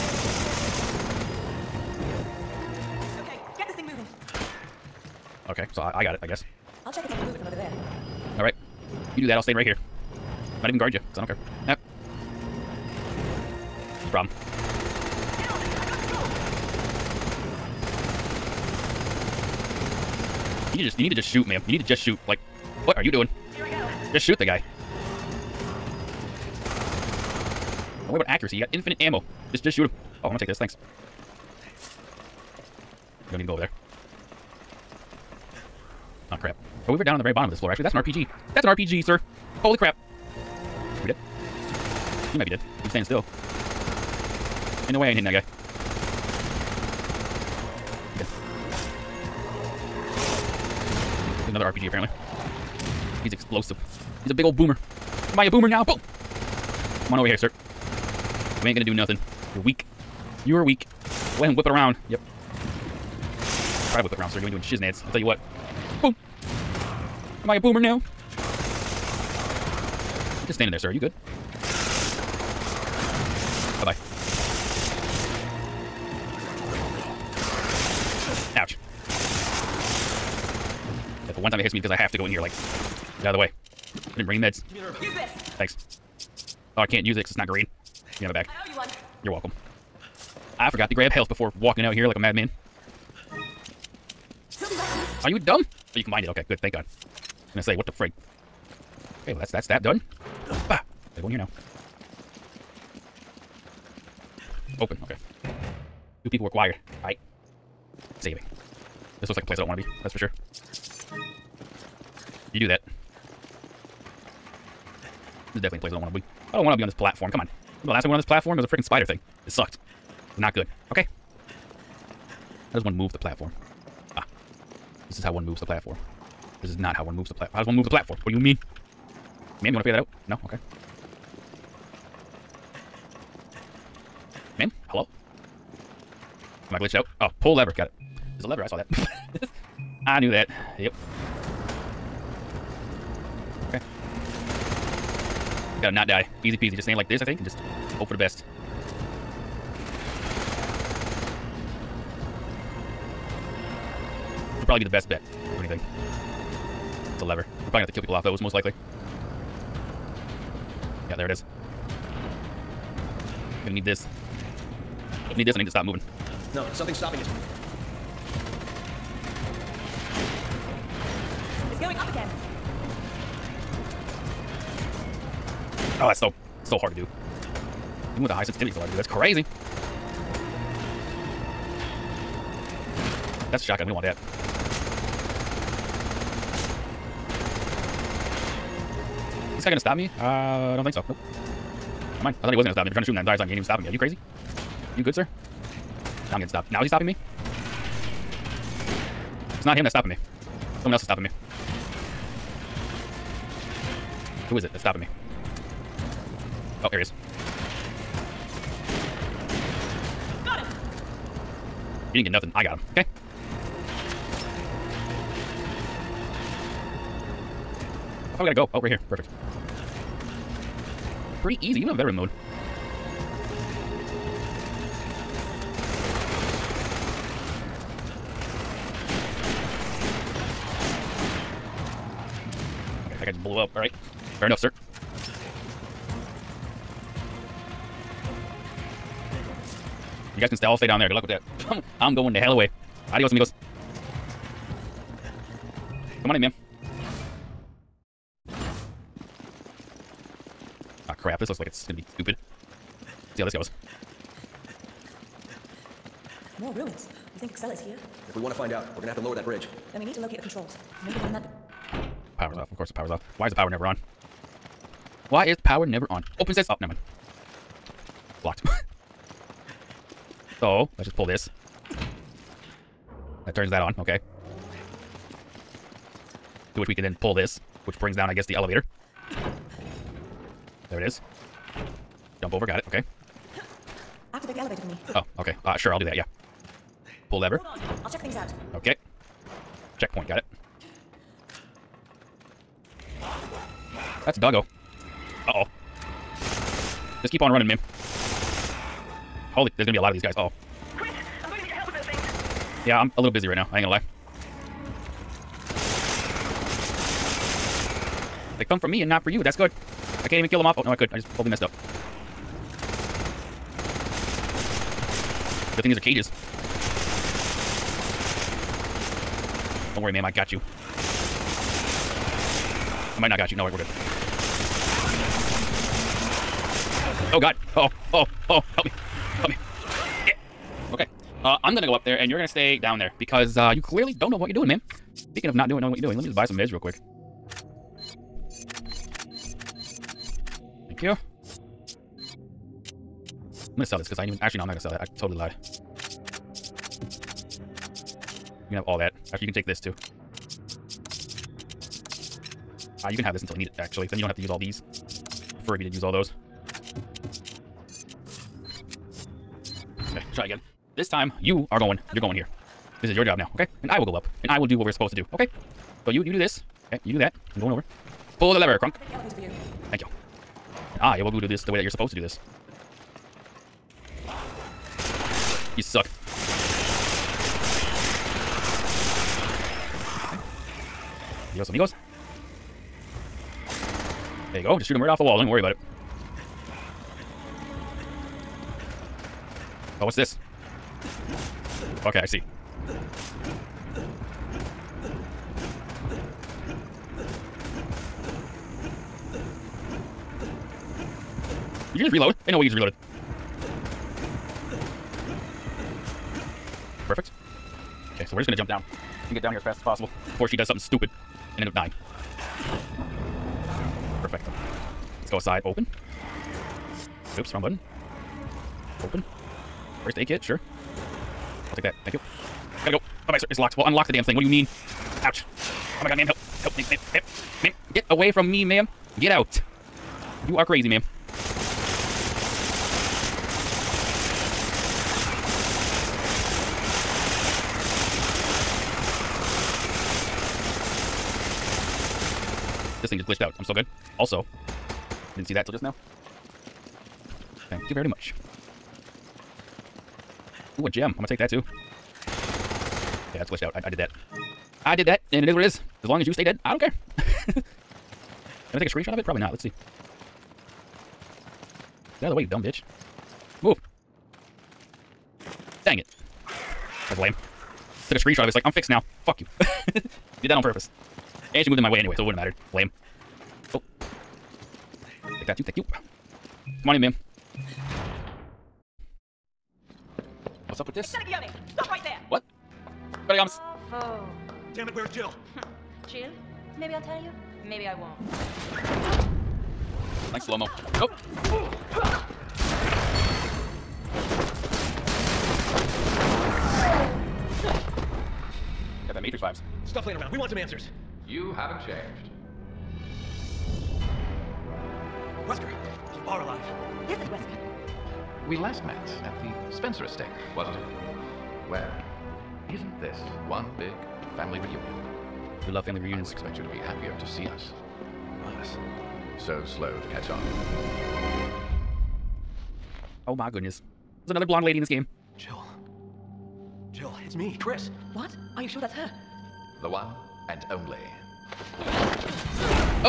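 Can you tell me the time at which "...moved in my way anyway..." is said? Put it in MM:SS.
07:51.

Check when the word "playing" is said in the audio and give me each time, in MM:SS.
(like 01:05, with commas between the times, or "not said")
08:20.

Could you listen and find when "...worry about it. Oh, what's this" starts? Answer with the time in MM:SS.
06:25.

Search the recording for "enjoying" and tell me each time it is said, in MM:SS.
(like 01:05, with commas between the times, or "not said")
not said.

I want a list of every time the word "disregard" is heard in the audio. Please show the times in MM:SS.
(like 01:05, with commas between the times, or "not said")
not said.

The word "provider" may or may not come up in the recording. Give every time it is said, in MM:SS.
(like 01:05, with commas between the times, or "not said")
not said.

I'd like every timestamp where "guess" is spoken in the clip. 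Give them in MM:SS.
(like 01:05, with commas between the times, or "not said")
00:06, 04:38.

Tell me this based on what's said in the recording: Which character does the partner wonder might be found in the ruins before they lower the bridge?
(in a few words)
Excella.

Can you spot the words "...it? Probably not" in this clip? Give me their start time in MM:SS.
07:39.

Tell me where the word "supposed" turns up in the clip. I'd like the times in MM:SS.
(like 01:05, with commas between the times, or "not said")
06:04, 06:11.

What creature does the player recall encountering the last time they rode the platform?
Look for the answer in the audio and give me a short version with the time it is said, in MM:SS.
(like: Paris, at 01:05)
spider thing, at 01:58.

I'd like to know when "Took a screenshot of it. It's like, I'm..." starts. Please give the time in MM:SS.
07:48.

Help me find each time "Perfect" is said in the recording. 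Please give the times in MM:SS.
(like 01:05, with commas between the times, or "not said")
03:39, 06:47, 06:54.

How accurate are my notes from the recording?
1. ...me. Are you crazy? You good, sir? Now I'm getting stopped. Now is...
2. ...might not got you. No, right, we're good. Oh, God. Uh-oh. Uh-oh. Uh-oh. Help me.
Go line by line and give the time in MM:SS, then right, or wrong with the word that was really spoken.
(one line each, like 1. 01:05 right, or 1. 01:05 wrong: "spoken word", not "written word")
1. 03:13 right
2. 05:23 right.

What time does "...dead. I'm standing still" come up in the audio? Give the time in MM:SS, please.
00:42.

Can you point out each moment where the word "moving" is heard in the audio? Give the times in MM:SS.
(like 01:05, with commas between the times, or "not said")
00:03, 02:45.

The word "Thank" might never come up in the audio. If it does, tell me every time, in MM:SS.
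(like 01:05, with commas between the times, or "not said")
00:30, 01:25, 01:36, 05:40, 06:09, 07:02, 07:27, 07:55.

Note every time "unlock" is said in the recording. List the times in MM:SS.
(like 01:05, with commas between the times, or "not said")
07:03.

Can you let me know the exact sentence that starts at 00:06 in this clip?
I'll check if I can move it from over there.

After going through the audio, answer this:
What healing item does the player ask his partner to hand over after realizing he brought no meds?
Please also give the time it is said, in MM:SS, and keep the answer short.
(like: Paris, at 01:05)
herb, at 01:24.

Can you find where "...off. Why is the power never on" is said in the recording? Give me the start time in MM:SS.
04:23.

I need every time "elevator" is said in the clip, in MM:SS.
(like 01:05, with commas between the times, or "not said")
04:38, 04:44.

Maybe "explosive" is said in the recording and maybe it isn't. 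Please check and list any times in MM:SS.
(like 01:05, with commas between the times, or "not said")
00:53.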